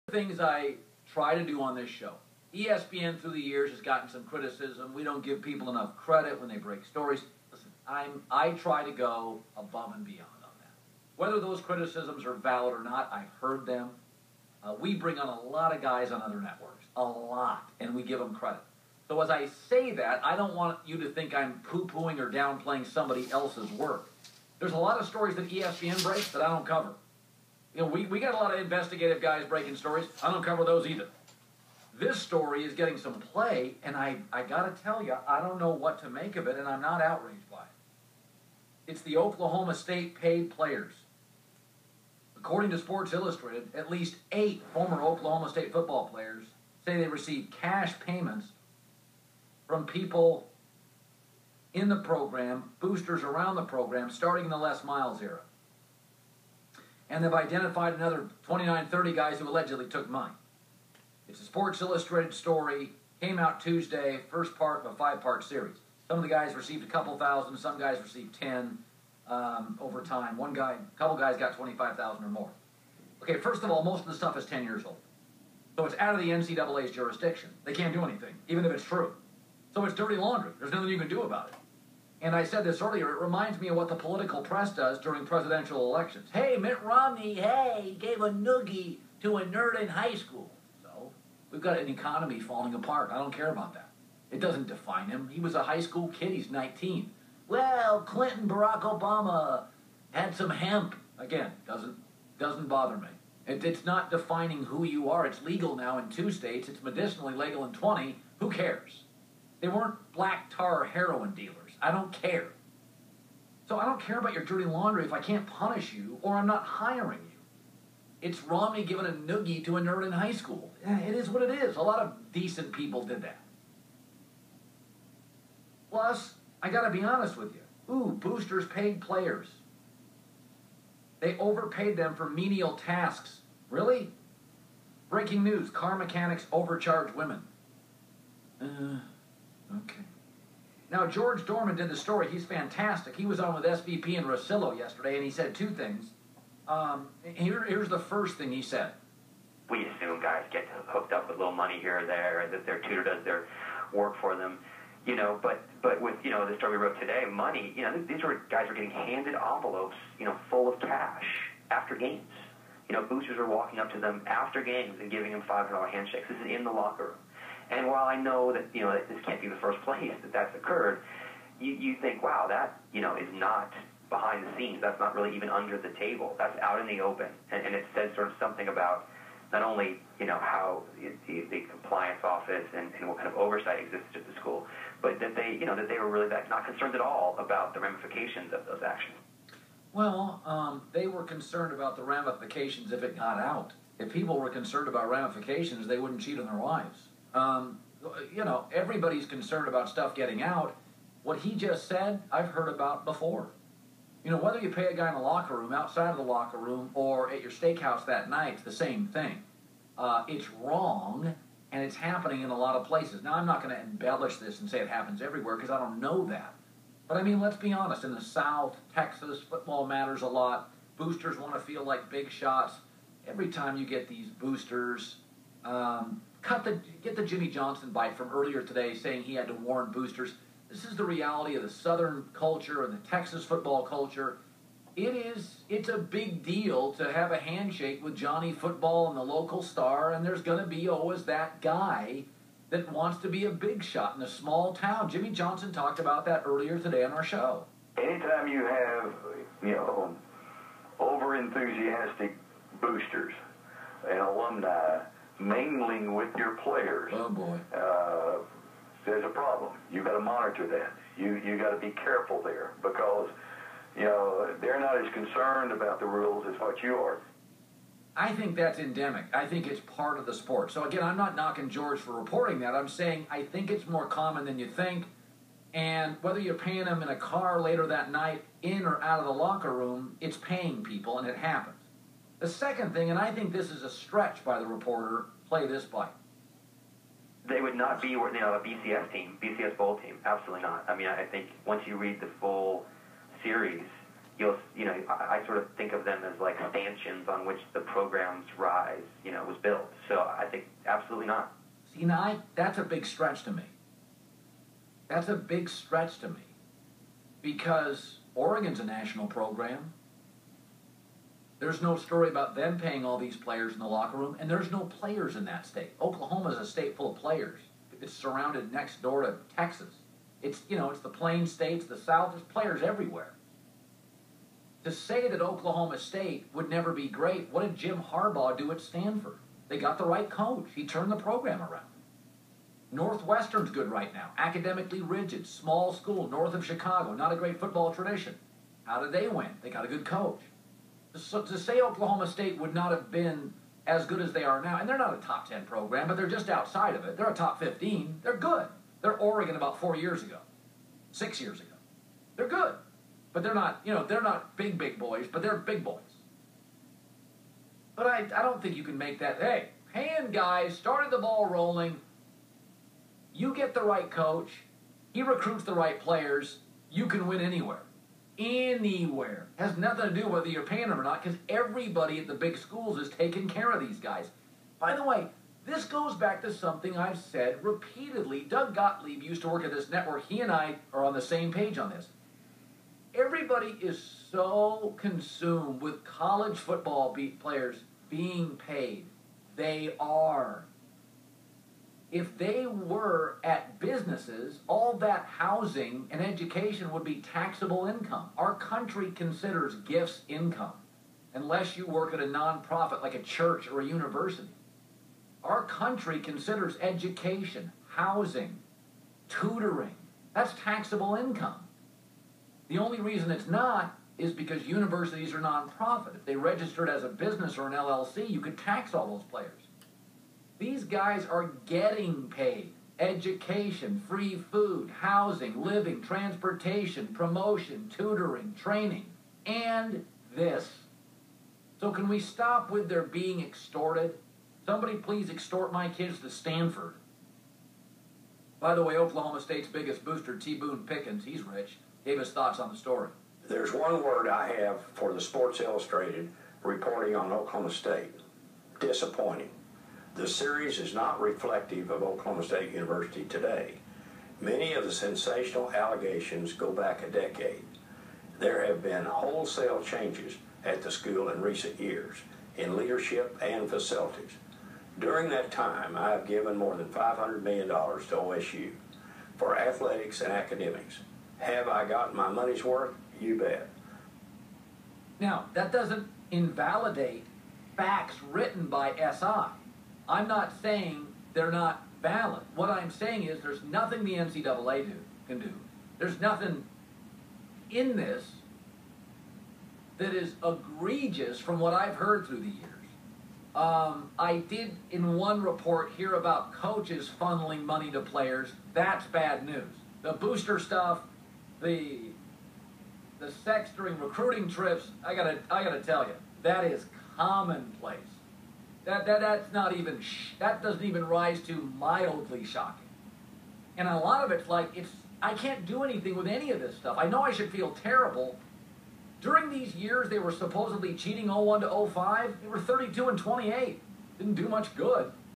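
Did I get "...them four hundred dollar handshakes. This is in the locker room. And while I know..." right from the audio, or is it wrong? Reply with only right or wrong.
wrong.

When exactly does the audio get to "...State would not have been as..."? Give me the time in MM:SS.
05:42.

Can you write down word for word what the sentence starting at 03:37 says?
But I mean, let's be honest.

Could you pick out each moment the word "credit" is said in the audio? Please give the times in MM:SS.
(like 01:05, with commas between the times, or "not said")
00:05, 00:18.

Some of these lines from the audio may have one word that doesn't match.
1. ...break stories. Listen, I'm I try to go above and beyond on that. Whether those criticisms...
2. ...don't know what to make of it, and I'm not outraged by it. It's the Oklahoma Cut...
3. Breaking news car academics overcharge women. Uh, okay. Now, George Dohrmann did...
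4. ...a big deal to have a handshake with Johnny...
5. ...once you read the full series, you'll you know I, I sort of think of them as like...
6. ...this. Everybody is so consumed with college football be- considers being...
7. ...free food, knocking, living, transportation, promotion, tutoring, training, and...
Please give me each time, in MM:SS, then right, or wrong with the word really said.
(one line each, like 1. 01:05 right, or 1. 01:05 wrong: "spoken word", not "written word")
1. 00:06 right
2. 00:35 wrong: "State", not "Cut"
3. 02:15 wrong: "mechanics", not "academics"
4. 03:55 right
5. 04:51 right
6. 06:21 wrong: "players", not "considers"
7. 07:04 wrong: "housing", not "knocking".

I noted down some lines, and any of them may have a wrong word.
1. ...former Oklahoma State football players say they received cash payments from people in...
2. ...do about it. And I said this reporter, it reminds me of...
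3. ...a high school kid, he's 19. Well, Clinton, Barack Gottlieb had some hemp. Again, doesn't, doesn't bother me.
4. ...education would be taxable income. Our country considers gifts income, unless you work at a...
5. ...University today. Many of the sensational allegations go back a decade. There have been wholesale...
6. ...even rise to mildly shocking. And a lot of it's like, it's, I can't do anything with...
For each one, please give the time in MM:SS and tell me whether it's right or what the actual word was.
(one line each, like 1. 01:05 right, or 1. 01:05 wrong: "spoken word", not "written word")
1. 00:44 right
2. 01:21 wrong: "earlier", not "reporter"
3. 01:35 wrong: "Obama", not "Gottlieb"
4. 06:36 right
5. 07:32 right
6. 08:30 right.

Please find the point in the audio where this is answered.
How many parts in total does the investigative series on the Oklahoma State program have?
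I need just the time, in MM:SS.
01:04.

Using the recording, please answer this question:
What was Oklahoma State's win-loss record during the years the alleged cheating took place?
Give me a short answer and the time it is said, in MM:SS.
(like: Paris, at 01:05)
32 and 28, at 08:42.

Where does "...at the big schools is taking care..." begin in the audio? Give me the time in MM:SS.
06:12.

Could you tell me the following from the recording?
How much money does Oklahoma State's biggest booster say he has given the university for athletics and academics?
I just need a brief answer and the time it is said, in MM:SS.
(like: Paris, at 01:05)
$500 million, at 07:46.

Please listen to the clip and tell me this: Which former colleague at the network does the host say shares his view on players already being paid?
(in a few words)
Doug Gottlieb.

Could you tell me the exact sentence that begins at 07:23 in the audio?
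There's one word I have for the Sports Illustrated reporting on Oklahoma State disappointing.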